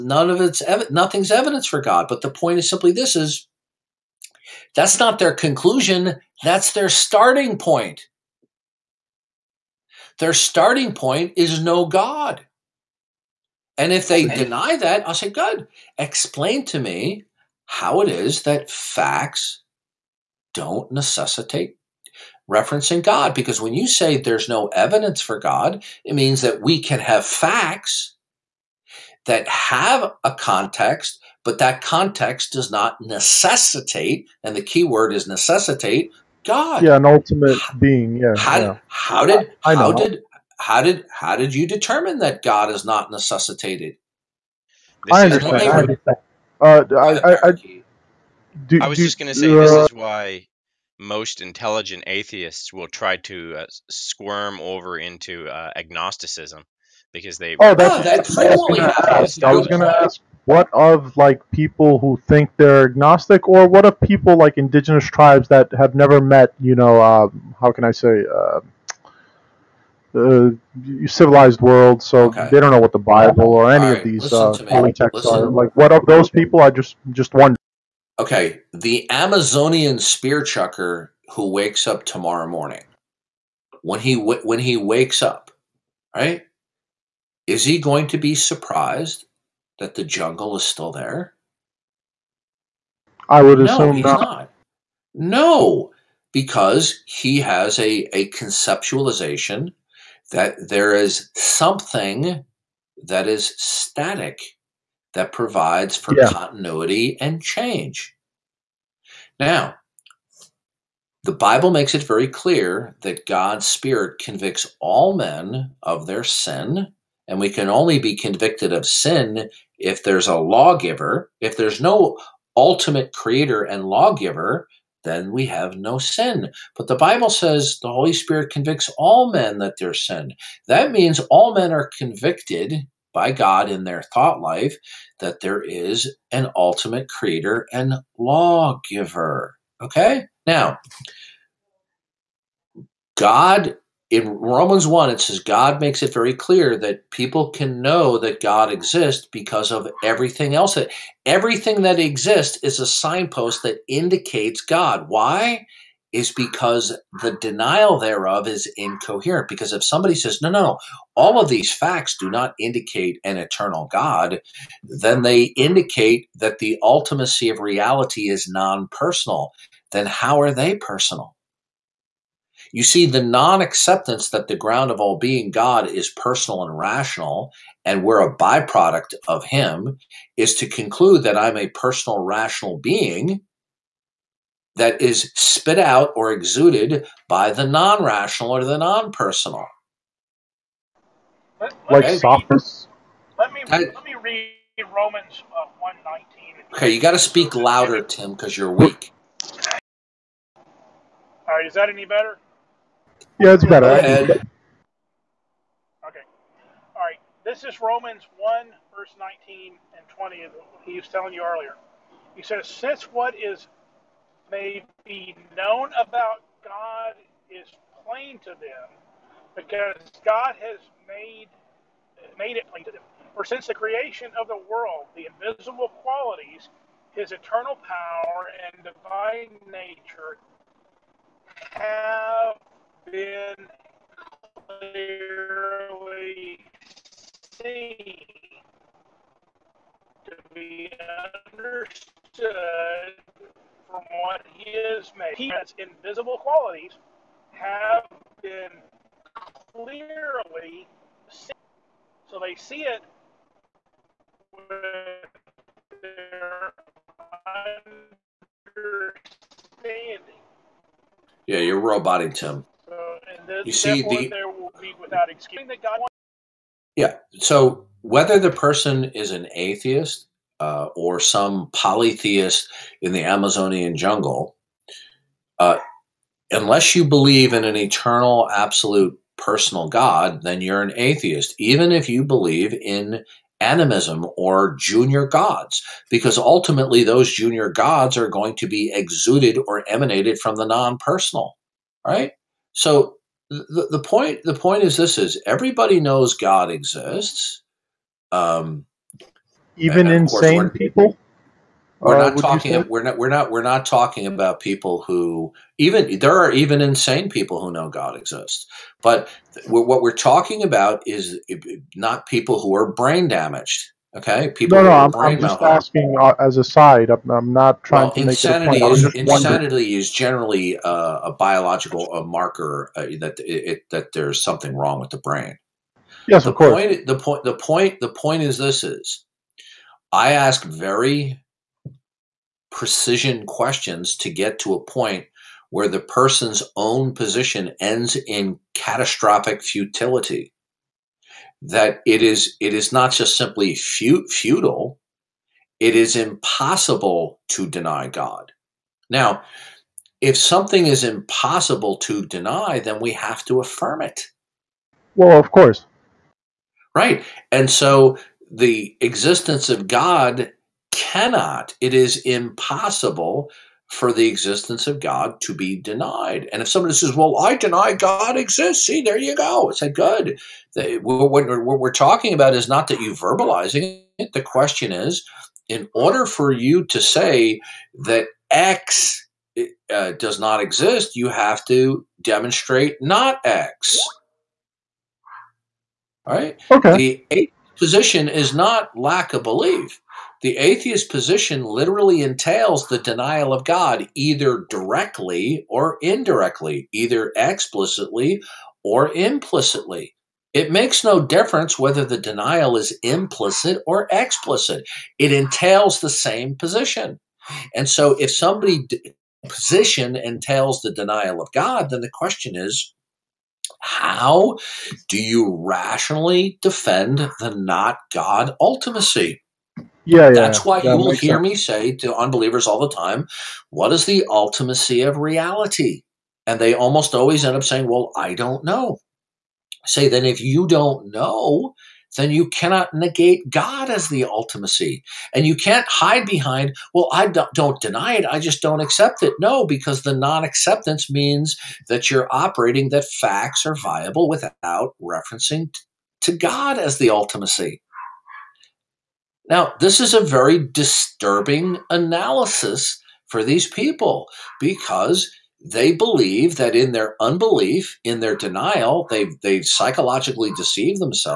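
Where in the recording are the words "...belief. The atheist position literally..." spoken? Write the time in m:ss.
6:29.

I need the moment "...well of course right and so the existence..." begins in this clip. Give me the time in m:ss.
5:55.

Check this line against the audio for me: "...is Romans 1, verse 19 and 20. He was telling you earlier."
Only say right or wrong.
right.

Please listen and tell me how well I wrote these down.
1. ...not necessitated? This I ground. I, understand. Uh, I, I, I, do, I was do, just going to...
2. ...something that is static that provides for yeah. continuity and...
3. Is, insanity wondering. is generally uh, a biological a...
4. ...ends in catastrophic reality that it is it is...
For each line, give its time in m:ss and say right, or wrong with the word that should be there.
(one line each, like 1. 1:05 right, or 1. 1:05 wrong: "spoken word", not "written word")
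1. 0:42 wrong: "understand", not "ground"
2. 1:41 right
3. 5:18 right
4. 5:37 wrong: "futility", not "reality".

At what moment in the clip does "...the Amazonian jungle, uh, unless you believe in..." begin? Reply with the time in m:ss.
4:33.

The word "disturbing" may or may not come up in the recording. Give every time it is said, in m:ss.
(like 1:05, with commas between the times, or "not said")
7:30.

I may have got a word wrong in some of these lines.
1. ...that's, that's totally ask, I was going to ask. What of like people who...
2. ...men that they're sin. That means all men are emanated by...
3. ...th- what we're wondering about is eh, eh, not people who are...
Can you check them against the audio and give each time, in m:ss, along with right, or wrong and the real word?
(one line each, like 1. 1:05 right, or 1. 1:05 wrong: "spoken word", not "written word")
1. 0:58 right
2. 2:09 wrong: "convicted", not "emanated"
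3. 5:09 wrong: "talking", not "wondering".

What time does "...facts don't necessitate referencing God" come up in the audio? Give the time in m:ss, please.
0:18.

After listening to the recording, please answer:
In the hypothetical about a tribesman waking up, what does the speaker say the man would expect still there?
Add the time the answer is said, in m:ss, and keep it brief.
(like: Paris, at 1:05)
the jungle, at 1:29.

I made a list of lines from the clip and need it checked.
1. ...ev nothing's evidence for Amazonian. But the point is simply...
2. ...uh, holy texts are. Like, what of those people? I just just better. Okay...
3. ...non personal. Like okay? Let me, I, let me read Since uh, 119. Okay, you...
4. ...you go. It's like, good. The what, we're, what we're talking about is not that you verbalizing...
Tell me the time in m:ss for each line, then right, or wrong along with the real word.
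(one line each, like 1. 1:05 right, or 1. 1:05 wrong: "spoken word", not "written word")
1. 0:00 wrong: "God", not "Amazonian"
2. 1:14 wrong: "wonder", not "better"
3. 3:08 wrong: "Romans", not "Since"
4. 6:09 right.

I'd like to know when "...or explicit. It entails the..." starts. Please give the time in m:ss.
6:43.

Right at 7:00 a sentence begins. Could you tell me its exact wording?
Yeah, That's why that you will hear sense.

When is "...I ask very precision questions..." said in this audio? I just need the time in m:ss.
5:30.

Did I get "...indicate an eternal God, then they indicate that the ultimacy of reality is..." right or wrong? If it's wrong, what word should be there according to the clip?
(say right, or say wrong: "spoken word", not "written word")
right.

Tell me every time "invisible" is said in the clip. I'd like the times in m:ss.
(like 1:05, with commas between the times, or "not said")
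3:45, 4:05.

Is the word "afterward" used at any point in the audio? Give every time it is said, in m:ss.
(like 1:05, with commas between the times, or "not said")
not said.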